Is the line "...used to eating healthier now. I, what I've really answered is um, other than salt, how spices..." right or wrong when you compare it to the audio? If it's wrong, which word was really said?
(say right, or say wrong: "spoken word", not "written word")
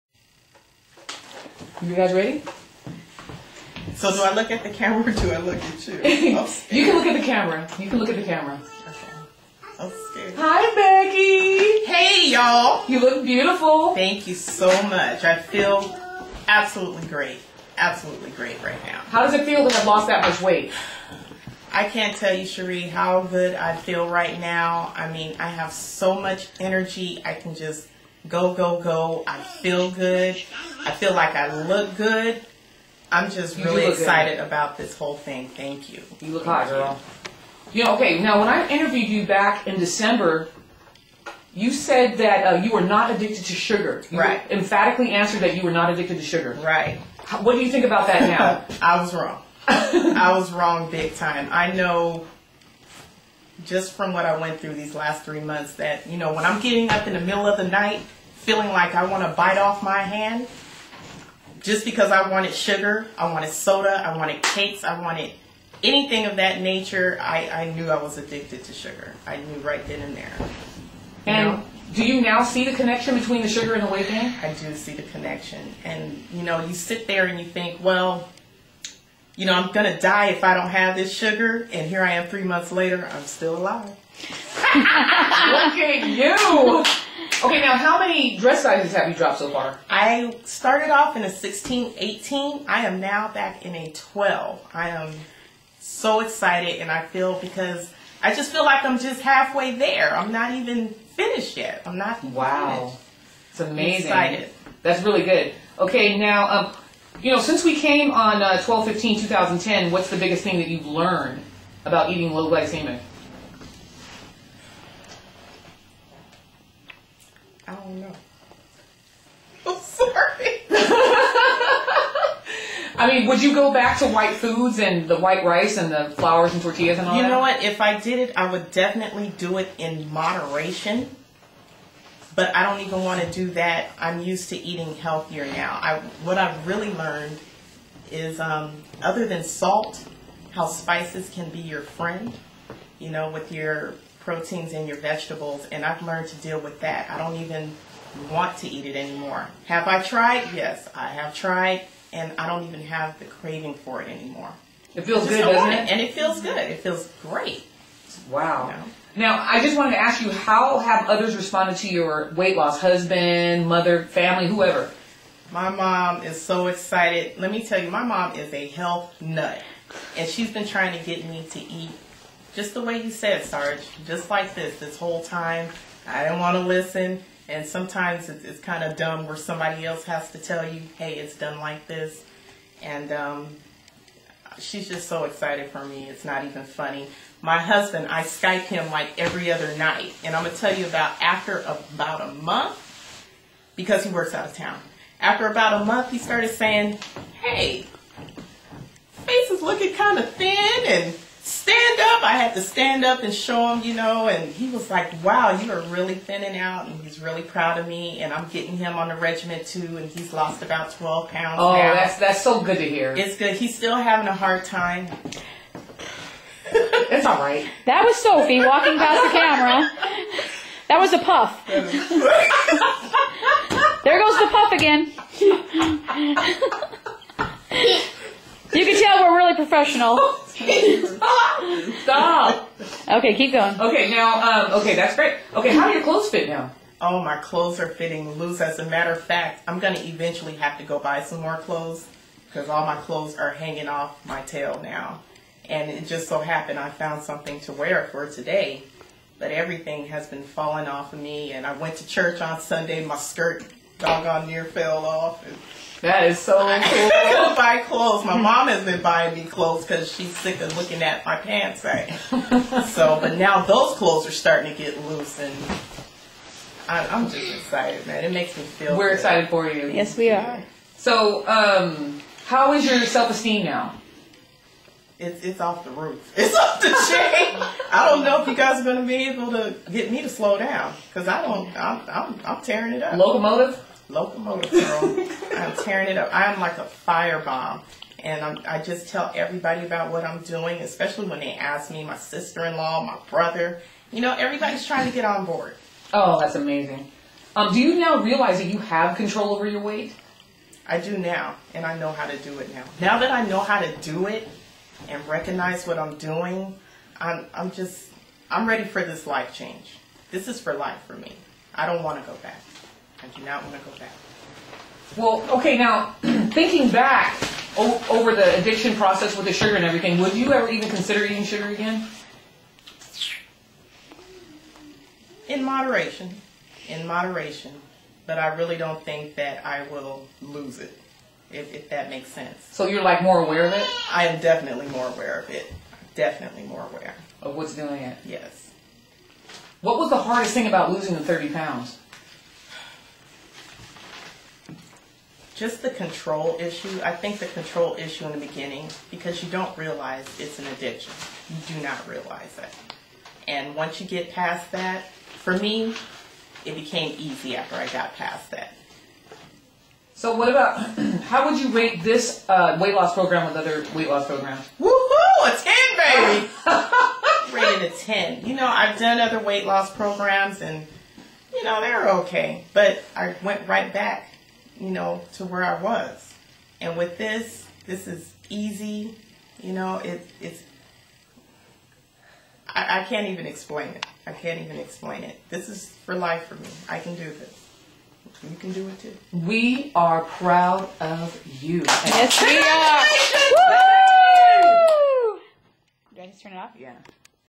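wrong: "learned", not "answered".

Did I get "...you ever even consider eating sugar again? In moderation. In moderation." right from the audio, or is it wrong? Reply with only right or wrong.
right.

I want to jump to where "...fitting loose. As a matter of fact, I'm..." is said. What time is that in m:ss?
3:57.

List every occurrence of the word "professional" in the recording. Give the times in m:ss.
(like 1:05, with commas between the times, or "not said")
3:49.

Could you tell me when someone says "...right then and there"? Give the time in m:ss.
1:09.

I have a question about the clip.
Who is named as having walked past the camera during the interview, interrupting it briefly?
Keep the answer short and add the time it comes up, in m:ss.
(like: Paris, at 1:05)
Sophie, at 3:38.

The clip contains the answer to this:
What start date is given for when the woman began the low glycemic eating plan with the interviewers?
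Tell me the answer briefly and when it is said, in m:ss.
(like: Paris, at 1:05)
12/15/2010, at 1:48.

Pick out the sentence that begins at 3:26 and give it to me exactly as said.
And he's really proud of me.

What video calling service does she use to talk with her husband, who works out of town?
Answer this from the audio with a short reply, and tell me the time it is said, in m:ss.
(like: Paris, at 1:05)
Skype, at 3:08.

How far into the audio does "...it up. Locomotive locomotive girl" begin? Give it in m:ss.
4:42.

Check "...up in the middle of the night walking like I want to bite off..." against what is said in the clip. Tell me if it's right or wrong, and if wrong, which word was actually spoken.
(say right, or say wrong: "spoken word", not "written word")
wrong: "feeling", not "walking".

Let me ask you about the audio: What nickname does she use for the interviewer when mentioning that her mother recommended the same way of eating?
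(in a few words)
Sarge.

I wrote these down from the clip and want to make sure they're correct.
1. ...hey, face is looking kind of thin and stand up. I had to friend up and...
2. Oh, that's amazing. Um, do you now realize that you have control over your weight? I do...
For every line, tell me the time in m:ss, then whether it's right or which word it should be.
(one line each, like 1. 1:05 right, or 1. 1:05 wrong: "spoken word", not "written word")
1. 3:17 wrong: "stand", not "friend"
2. 4:56 right.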